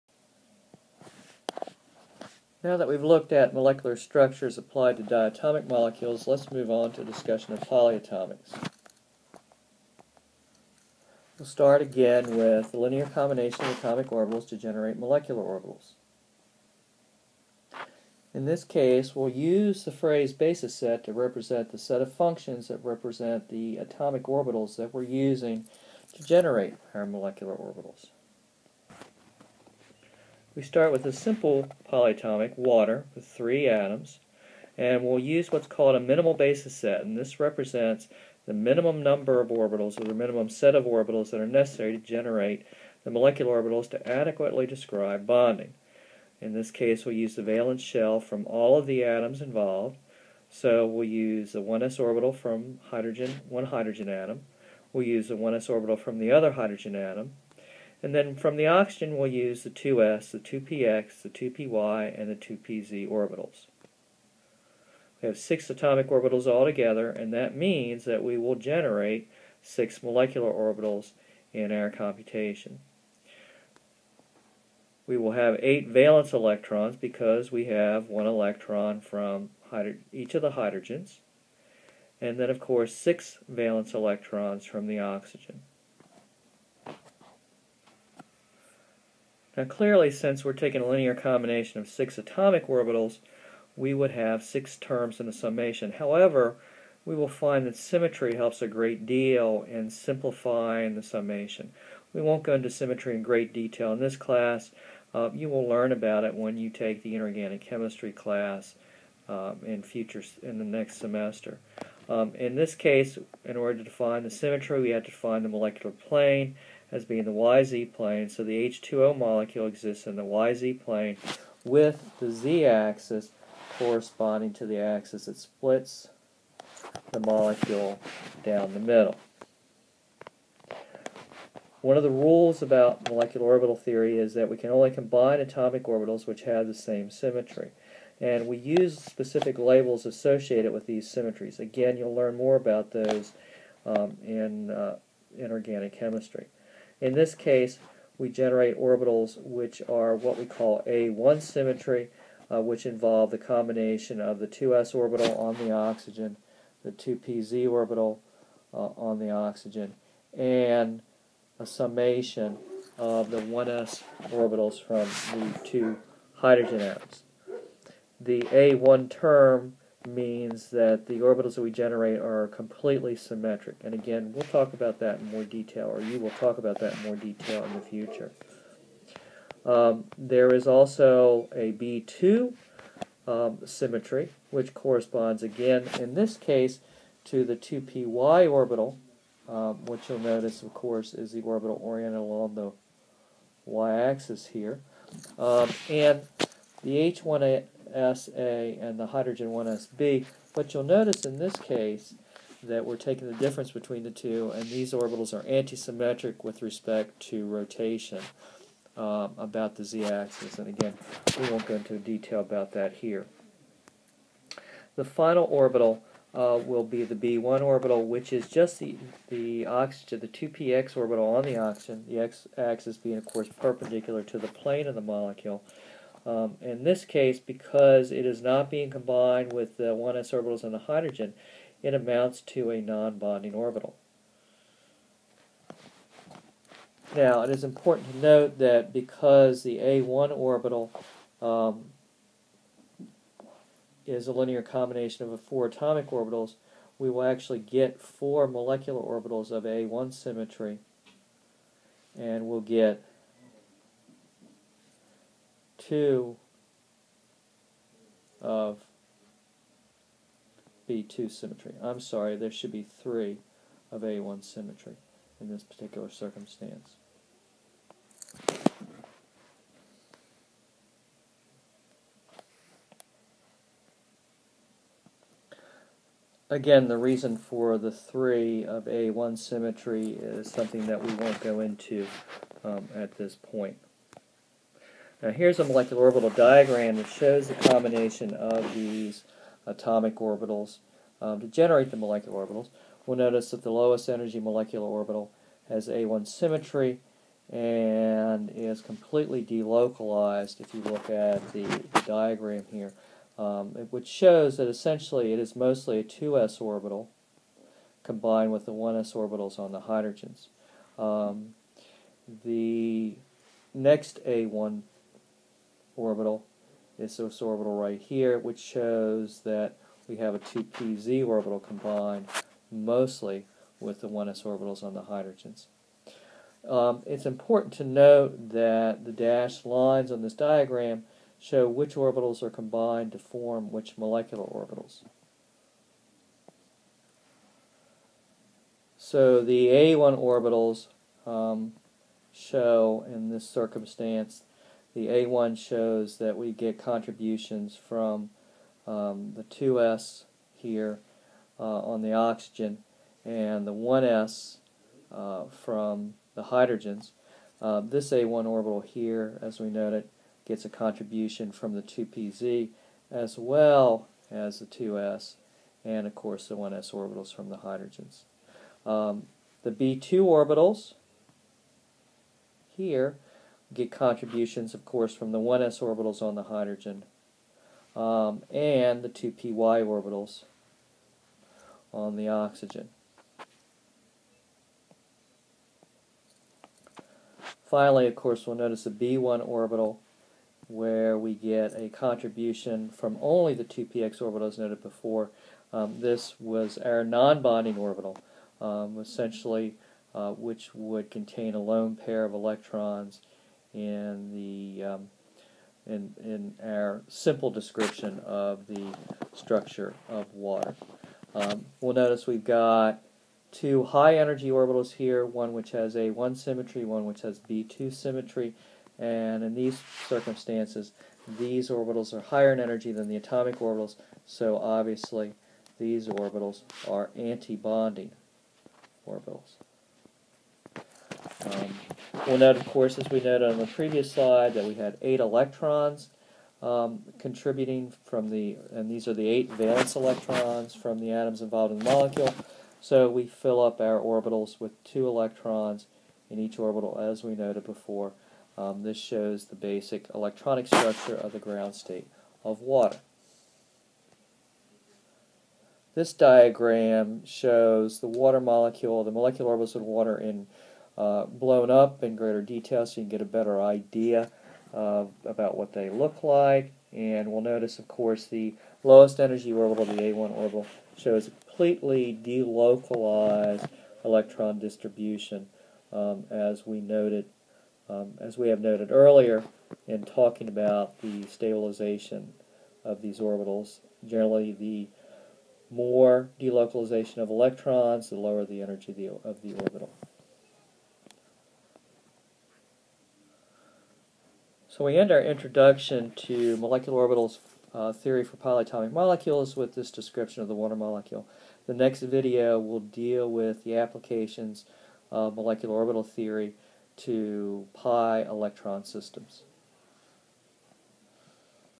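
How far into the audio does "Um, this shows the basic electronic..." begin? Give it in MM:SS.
07:28.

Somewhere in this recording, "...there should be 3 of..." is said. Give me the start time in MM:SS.
04:22.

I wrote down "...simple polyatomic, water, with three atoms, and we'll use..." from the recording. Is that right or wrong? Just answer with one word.
right.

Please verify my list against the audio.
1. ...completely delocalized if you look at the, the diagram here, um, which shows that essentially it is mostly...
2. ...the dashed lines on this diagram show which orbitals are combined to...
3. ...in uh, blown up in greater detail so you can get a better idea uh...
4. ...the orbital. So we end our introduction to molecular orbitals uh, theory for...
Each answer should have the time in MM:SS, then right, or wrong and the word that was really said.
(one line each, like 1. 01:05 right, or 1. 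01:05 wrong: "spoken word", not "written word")
1. 04:58 right
2. 05:29 right
3. 07:40 right
4. 08:09 right.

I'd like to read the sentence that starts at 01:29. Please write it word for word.
Now clearly, since we're taking a linear combination of six atomic orbitals, we would have six terms in the summation.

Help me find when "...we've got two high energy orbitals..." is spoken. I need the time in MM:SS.
06:52.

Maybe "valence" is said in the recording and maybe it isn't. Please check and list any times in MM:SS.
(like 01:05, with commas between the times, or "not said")
00:47, 01:15, 01:23, 07:19.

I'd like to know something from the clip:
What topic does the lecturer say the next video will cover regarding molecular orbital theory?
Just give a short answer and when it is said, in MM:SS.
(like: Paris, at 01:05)
pi electron systems, at 08:27.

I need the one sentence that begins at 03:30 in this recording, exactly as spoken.
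And again, we won't go into detail about that here.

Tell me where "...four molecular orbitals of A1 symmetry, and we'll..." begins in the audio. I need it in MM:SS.
04:07.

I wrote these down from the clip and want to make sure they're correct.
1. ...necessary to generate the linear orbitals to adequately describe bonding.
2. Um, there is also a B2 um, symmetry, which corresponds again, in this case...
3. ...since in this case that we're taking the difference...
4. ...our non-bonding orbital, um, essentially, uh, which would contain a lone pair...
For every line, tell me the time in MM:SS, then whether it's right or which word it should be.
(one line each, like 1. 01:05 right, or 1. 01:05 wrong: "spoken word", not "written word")
1. 00:41 wrong: "molecular", not "linear"
2. 02:59 right
3. 03:20 wrong: "notice", not "since"
4. 06:36 right.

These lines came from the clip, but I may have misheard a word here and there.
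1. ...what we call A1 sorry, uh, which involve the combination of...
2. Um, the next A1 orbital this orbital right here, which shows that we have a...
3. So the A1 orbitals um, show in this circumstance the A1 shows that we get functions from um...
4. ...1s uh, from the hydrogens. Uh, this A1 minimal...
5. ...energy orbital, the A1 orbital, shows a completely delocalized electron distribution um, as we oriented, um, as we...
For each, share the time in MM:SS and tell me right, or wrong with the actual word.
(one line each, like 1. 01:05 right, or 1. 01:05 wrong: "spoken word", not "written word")
1. 02:30 wrong: "symmetry", not "sorry"
2. 05:10 right
3. 05:38 wrong: "contributions", not "functions"
4. 05:53 wrong: "orbital", not "minimal"
5. 07:49 wrong: "noted", not "oriented".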